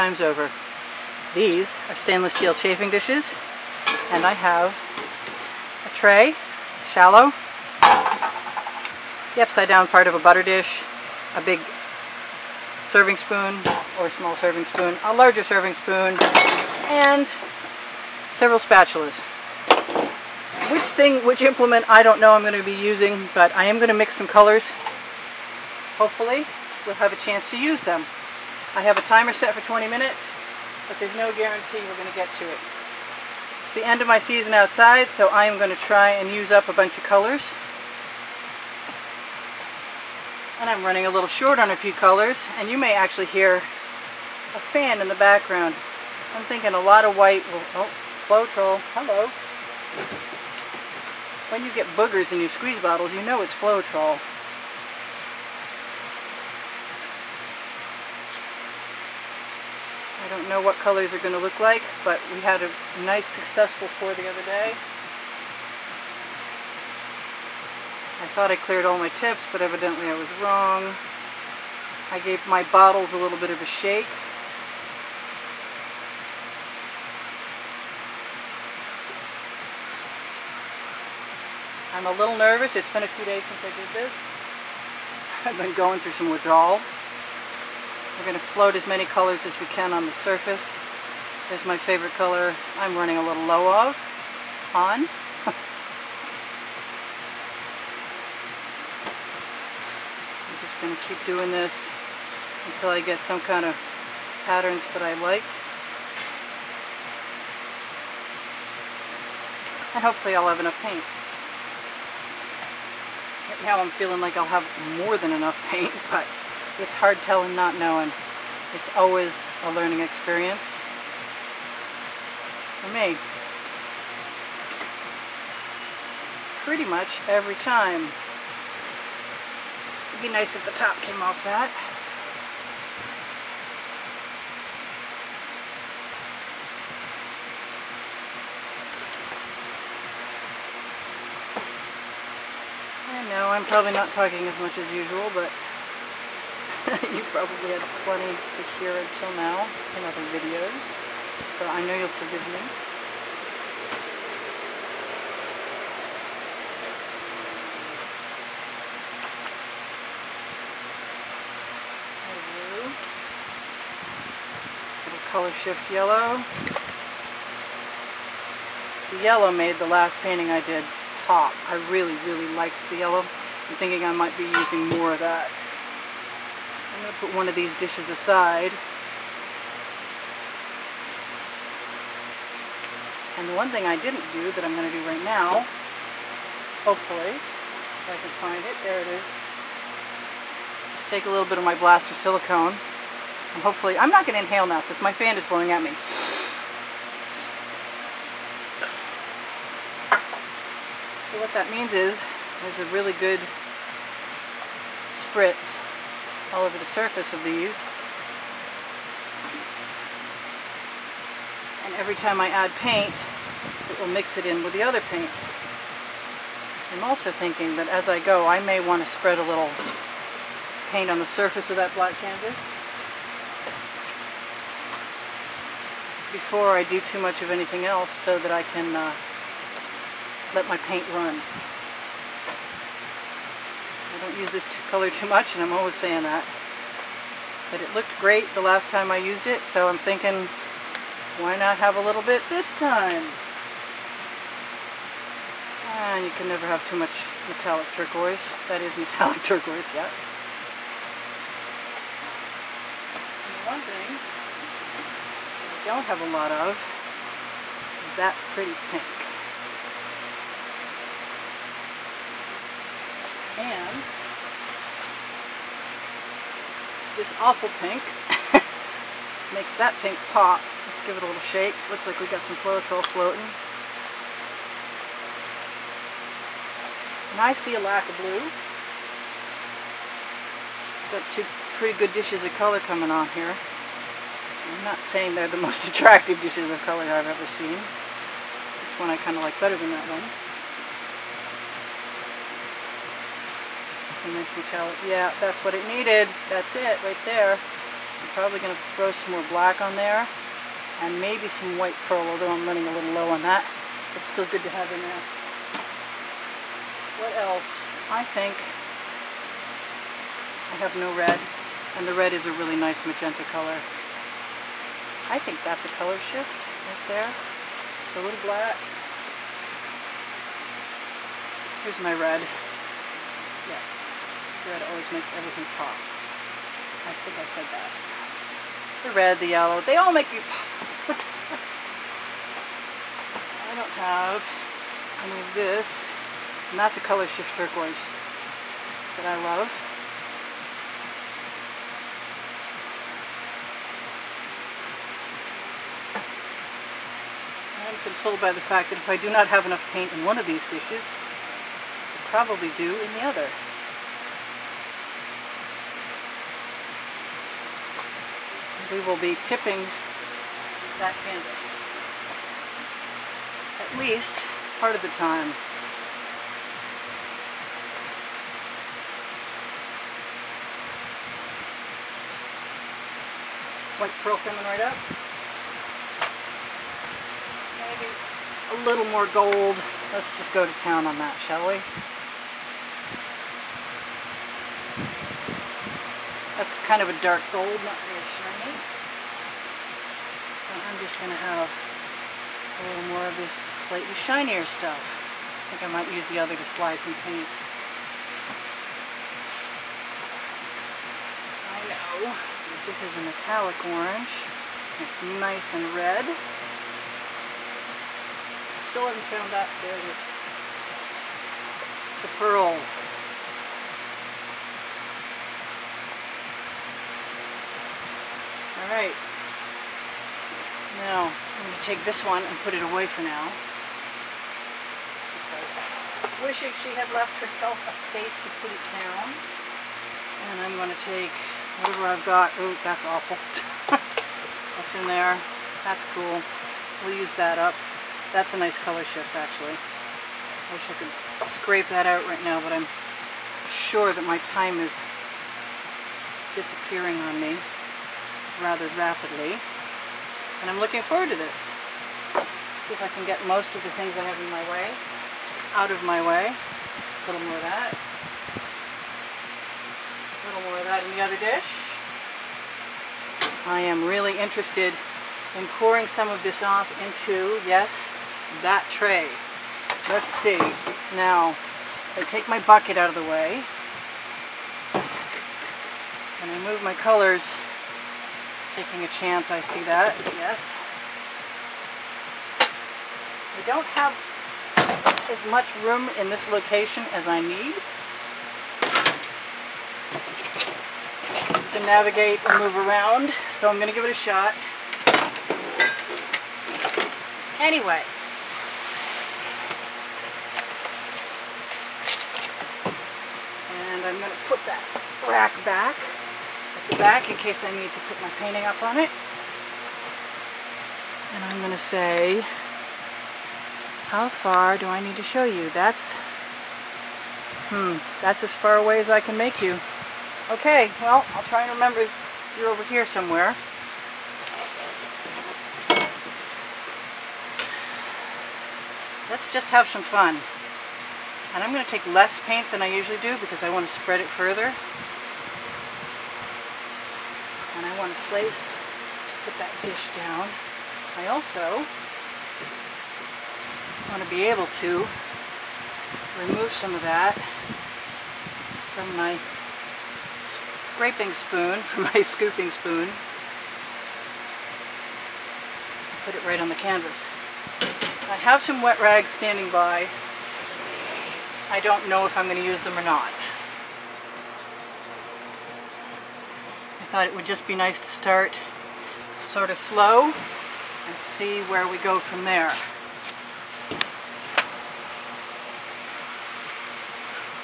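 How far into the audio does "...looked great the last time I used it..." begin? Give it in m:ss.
3:57.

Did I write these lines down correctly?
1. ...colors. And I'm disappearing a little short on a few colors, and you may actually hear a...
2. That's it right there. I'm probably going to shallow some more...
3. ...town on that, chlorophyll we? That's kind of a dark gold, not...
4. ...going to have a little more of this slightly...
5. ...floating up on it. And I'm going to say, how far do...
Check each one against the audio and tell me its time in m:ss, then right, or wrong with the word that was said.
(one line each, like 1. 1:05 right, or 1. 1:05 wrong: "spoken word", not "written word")
1. 0:37 wrong: "running", not "disappearing"
2. 4:56 wrong: "throw", not "shallow"
3. 6:20 wrong: "shall", not "chlorophyll"
4. 6:31 right
5. 8:28 wrong: "painting", not "floating".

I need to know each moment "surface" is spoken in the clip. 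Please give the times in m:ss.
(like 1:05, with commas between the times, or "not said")
1:30, 3:26, 3:41.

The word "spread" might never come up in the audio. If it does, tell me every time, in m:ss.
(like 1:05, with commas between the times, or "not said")
3:39, 8:53.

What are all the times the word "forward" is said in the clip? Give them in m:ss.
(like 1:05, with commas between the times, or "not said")
7:31.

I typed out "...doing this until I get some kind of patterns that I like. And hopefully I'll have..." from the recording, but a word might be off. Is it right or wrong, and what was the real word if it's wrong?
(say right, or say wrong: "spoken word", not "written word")
right.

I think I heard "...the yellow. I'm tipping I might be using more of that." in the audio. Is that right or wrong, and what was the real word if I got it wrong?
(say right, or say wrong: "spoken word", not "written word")
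wrong: "thinking", not "tipping".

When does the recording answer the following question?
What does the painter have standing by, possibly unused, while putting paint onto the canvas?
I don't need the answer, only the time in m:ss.
9:18.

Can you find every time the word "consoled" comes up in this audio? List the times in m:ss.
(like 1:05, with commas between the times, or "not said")
5:48.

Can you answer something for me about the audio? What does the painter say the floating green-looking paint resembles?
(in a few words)
chlorophyll.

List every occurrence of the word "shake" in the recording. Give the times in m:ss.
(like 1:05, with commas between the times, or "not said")
1:13, 4:31.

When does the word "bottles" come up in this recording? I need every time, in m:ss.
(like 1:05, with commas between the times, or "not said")
0:52, 1:12.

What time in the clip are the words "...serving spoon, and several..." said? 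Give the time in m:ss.
0:15.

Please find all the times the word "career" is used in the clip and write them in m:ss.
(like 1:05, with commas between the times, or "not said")
not said.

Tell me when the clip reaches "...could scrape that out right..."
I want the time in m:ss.
7:20.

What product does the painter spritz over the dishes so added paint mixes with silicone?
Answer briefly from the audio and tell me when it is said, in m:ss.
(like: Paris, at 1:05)
blaster silicone, at 3:11.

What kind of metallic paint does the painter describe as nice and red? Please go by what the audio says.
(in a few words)
metallic orange.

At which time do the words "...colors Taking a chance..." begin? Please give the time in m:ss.
7:56.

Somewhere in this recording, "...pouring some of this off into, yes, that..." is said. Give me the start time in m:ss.
7:45.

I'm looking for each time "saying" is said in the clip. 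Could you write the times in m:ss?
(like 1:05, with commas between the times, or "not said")
3:55, 4:45.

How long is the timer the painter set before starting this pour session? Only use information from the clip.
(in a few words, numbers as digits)
20 minutes.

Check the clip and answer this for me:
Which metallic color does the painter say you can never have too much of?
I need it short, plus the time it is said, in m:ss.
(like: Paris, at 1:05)
metallic turquoise, at 4:07.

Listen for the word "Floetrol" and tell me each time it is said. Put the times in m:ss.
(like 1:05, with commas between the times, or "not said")
0:48, 0:53.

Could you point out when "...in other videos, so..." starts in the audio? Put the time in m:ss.
2:29.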